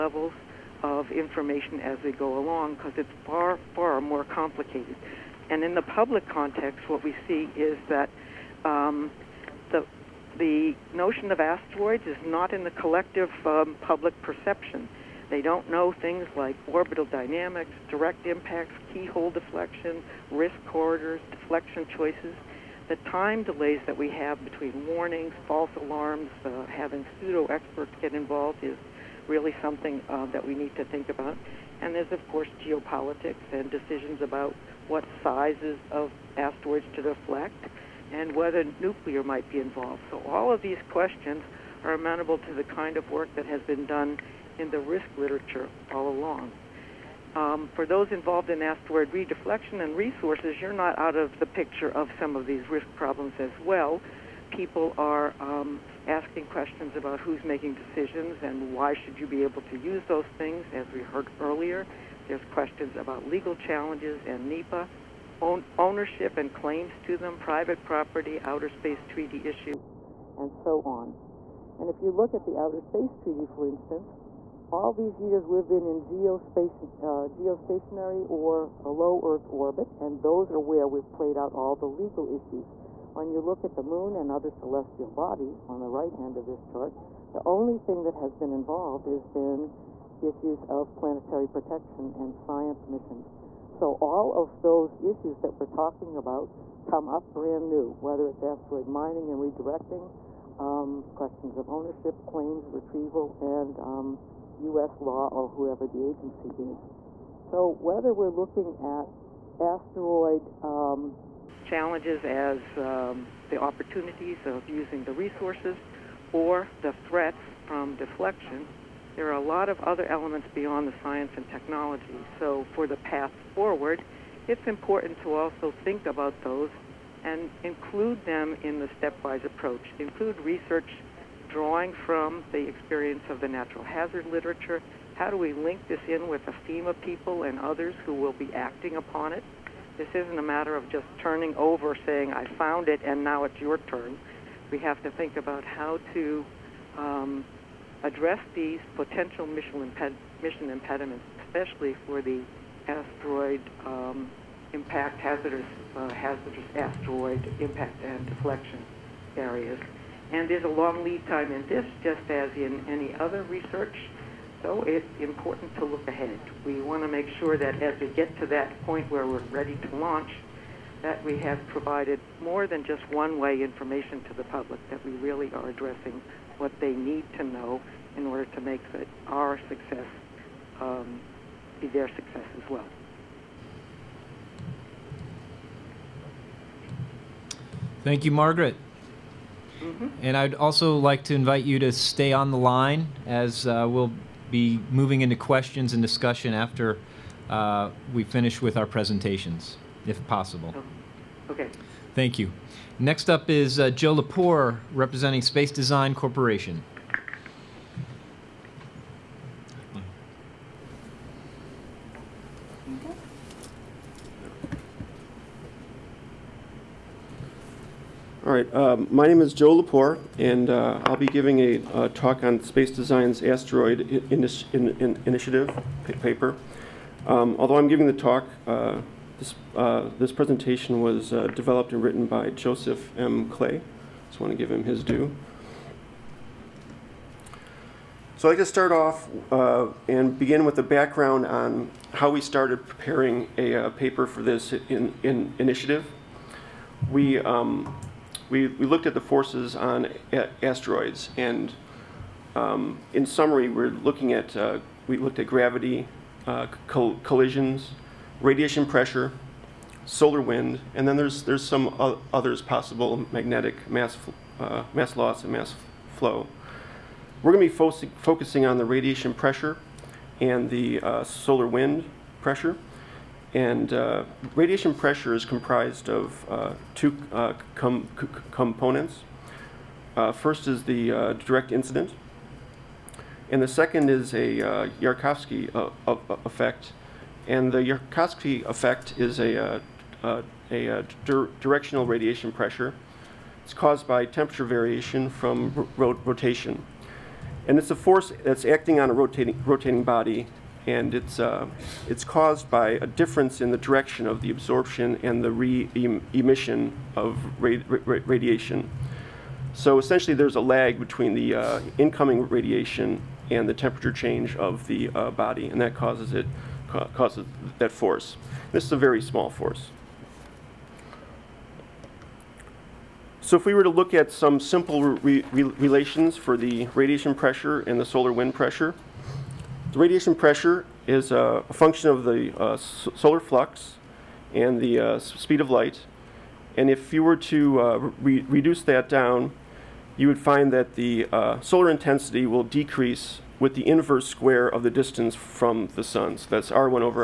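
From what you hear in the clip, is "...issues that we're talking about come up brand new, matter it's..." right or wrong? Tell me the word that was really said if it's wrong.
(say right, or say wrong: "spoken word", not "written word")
wrong: "whether", not "matter".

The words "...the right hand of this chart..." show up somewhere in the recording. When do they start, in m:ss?
1:25.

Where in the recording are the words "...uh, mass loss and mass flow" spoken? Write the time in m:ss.
4:24.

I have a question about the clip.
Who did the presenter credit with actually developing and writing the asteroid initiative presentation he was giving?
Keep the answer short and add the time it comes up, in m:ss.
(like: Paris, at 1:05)
Joseph M. Clay, at 3:52.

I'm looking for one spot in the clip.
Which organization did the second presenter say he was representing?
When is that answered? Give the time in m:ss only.
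3:25.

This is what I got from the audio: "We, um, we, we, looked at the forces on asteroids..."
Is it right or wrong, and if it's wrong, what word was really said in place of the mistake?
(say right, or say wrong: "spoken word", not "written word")
right.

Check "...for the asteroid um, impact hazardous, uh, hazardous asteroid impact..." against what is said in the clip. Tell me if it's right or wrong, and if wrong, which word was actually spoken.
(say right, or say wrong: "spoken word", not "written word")
right.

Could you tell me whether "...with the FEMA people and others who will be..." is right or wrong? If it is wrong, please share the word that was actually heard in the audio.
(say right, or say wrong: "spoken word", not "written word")
right.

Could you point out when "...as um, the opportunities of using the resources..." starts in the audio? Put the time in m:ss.
1:52.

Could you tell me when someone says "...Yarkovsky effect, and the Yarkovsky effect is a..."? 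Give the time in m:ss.
4:44.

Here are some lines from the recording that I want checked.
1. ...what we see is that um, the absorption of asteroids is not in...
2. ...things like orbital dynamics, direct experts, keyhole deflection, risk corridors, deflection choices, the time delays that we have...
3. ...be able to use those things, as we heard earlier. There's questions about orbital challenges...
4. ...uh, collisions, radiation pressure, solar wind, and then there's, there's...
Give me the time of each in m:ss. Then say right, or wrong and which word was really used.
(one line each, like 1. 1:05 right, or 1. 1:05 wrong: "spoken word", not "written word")
1. 0:06 wrong: "notion", not "absorption"
2. 0:15 wrong: "impacts", not "experts"
3. 0:59 wrong: "legal", not "orbital"
4. 4:16 right.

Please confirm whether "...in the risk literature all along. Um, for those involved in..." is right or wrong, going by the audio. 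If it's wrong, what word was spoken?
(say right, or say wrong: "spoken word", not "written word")
right.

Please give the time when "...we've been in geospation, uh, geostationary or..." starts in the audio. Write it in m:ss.
1:15.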